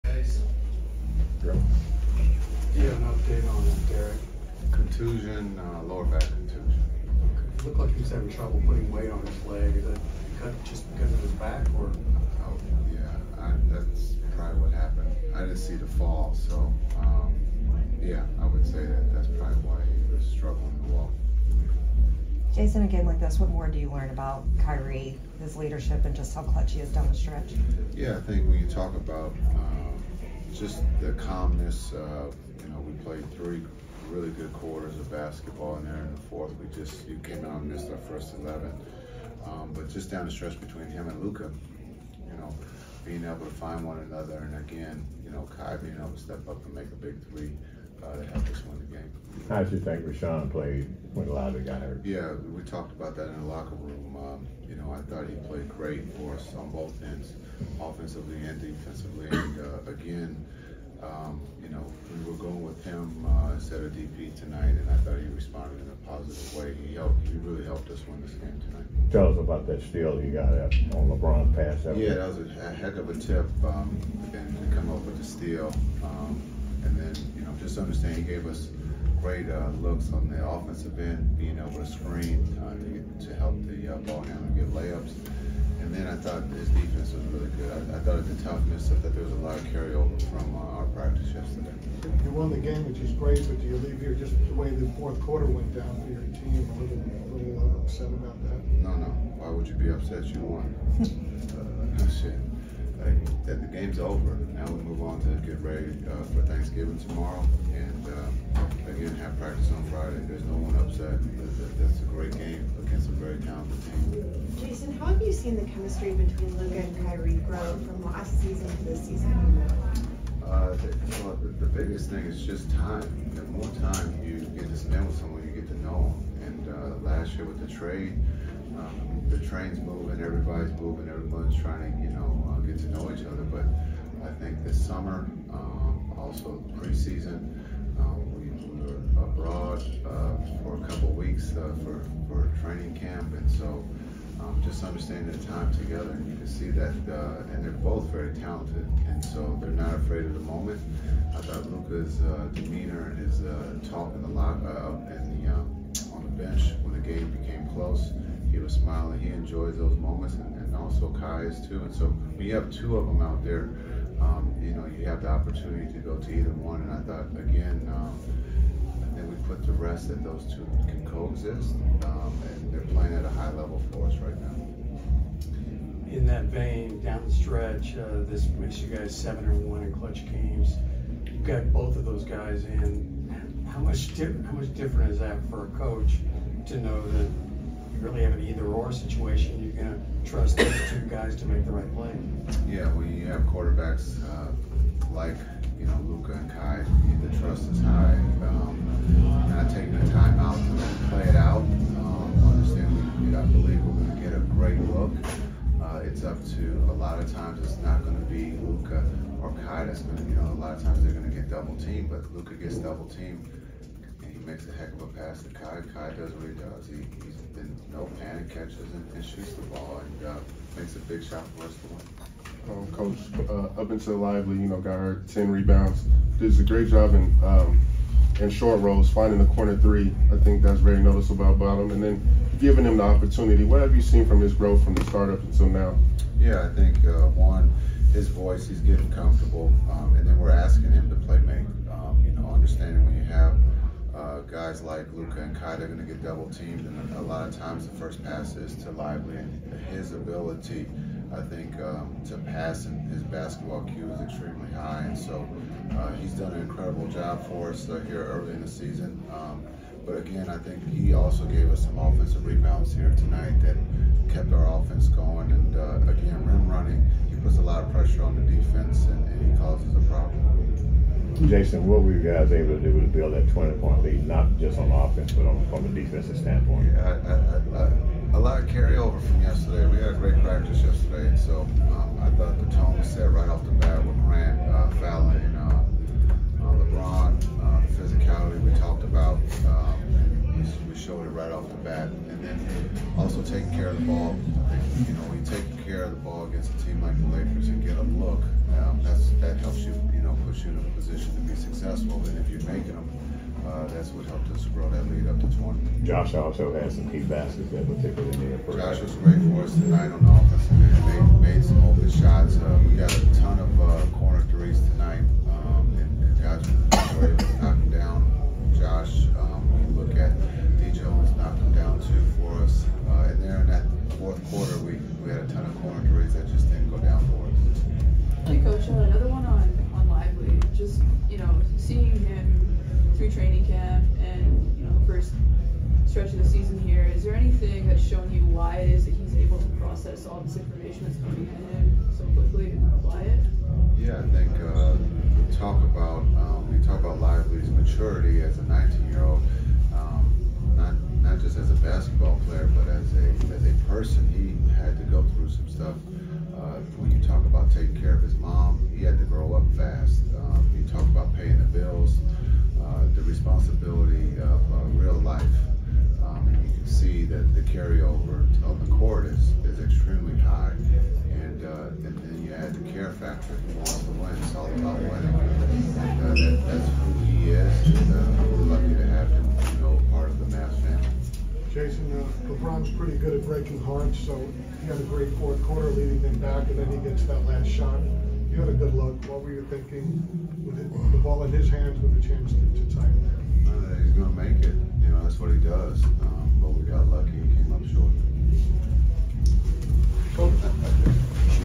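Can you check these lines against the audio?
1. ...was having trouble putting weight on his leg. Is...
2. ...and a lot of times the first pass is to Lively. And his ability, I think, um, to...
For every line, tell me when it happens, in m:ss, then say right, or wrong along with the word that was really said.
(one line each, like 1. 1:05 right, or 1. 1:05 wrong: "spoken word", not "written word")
1. 0:08 right
2. 4:06 right.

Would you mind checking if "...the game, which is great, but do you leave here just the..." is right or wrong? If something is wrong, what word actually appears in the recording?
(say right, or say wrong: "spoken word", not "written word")
right.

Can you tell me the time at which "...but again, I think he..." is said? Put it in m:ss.
4:20.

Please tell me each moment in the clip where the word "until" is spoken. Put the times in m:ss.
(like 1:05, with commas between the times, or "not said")
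3:43, 3:55.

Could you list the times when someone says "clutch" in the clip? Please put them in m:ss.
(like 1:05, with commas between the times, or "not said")
0:26, 2:59.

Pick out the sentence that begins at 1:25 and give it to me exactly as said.
And then I thought his defense was really good.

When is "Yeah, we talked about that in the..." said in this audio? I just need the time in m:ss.
0:52.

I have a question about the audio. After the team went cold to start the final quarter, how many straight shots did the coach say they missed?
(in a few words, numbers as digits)
11.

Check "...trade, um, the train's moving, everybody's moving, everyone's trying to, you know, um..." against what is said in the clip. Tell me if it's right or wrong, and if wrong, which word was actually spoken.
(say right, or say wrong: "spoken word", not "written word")
right.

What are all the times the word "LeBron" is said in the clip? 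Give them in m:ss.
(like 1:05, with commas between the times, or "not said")
1:11, 4:46, 6:22.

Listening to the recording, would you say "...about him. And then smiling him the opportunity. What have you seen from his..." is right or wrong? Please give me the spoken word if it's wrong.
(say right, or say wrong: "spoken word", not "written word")
wrong: "giving", not "smiling".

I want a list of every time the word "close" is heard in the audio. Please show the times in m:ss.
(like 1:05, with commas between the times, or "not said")
2:37.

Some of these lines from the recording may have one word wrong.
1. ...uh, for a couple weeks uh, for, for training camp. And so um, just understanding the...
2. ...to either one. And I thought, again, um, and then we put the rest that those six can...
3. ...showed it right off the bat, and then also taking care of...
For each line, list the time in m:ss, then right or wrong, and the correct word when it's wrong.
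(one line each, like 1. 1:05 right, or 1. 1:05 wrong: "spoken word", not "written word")
1. 2:20 right
2. 2:46 wrong: "two", not "six"
3. 4:51 right.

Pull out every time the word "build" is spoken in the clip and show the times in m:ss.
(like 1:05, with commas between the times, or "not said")
4:33.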